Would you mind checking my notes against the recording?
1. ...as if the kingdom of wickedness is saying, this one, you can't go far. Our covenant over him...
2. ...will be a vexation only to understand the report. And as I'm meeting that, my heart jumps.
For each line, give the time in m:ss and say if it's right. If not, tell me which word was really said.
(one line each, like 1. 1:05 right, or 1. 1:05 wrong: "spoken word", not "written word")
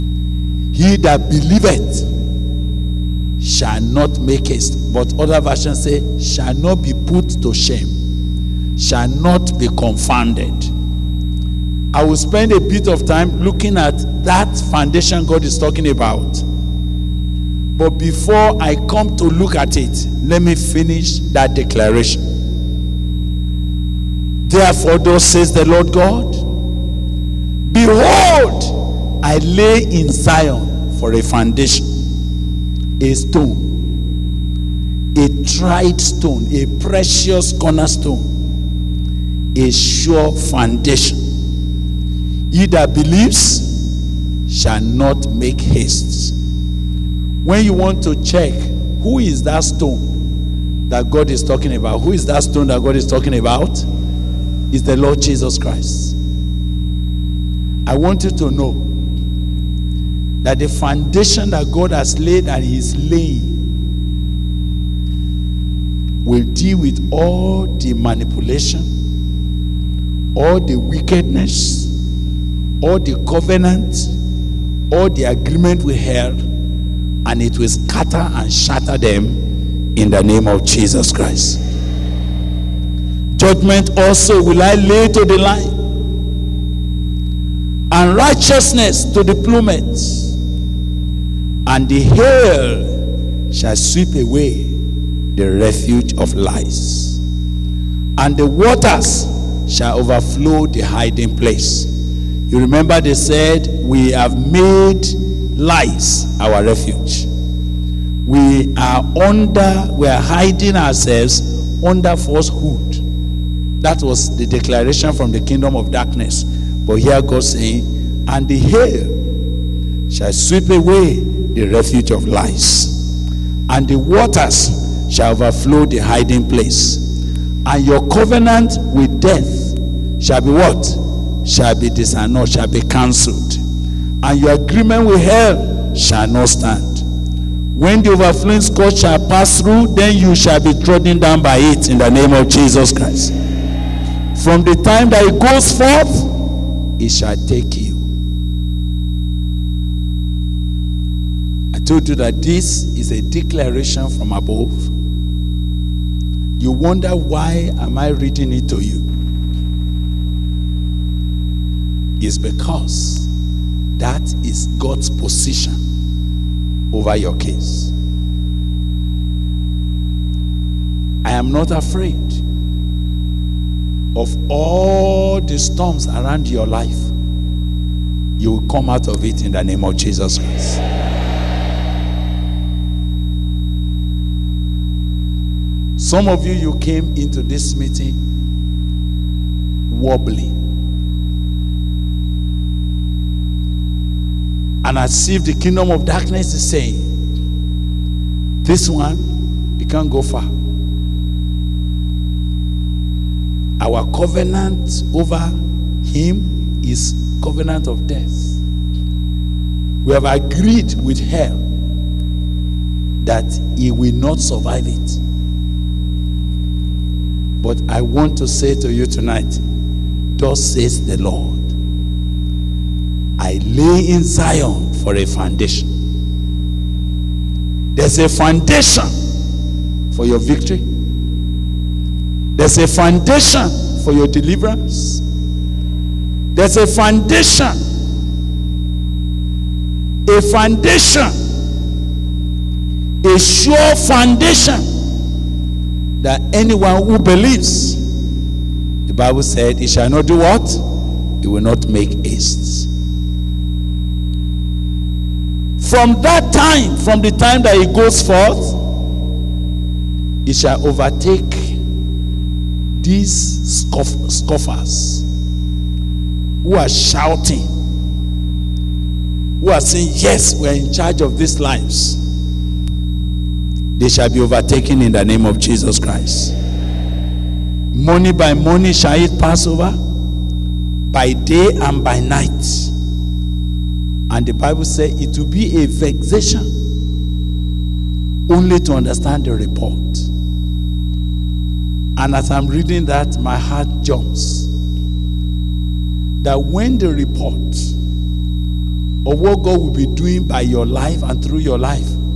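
1. 3:14 wrong: "darkness", not "wickedness"
2. 4:45 wrong: "reading", not "meeting".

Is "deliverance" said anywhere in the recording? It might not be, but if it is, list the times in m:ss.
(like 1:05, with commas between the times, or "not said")
3:54.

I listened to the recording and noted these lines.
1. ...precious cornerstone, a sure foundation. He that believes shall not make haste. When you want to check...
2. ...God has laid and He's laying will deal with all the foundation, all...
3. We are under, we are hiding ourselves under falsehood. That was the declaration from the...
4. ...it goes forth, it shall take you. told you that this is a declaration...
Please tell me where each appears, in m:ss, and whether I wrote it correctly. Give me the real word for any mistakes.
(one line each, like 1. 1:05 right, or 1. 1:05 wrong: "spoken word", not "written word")
1. 0:36 right
2. 1:01 wrong: "manipulation", not "foundation"
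3. 1:48 right
4. 2:25 right.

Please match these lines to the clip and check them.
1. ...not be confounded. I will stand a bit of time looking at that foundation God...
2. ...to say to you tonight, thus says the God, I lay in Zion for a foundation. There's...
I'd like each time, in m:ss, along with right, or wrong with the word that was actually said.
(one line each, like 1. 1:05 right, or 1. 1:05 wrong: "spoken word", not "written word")
1. 0:09 wrong: "spend", not "stand"
2. 3:38 wrong: "Lord", not "God".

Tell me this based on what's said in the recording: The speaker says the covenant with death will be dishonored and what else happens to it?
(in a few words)
cancelled.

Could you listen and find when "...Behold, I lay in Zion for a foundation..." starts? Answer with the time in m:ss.
0:27.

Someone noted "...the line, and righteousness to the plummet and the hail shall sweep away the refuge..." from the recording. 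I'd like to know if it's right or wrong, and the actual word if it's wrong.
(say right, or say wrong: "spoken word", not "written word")
right.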